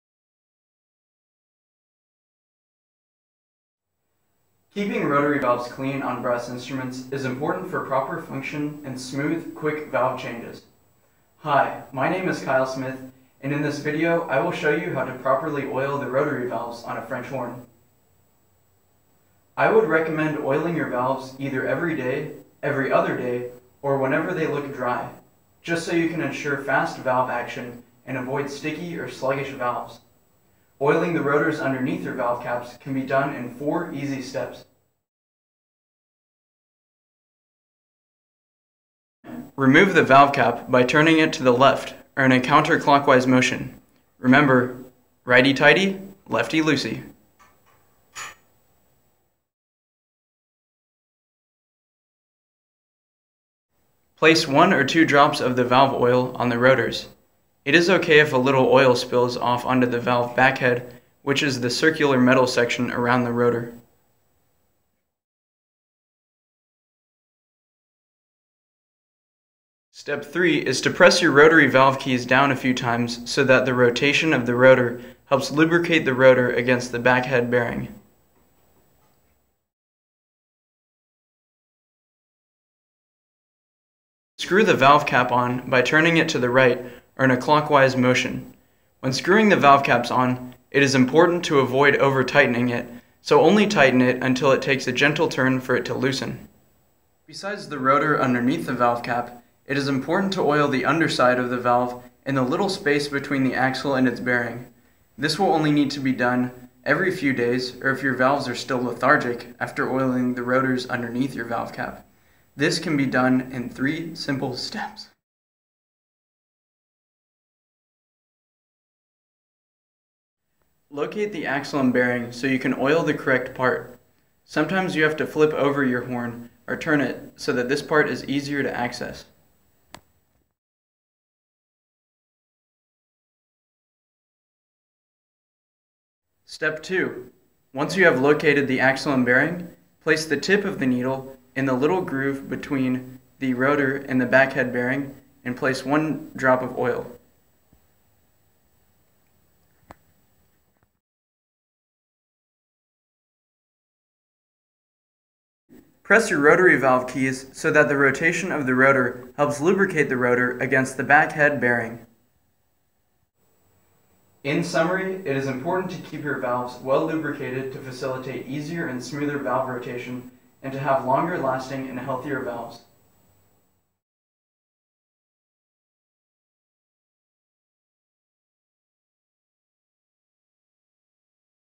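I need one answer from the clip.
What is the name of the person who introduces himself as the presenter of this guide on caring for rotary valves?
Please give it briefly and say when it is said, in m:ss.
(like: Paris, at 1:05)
Kyle Smith, at 0:12.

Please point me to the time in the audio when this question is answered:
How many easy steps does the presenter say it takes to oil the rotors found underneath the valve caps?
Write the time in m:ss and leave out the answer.
0:33.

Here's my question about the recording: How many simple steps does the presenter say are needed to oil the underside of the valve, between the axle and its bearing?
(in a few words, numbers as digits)
3.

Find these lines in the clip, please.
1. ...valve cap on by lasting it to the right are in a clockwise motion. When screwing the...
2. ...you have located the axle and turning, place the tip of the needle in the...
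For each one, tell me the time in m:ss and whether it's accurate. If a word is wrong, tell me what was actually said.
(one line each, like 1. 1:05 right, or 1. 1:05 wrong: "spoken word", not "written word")
1. 1:24 wrong: "turning", not "lasting"
2. 2:17 wrong: "bearing", not "turning".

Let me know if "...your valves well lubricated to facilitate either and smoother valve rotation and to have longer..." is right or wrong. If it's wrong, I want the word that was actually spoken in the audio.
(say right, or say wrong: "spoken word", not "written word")
wrong: "easier", not "either".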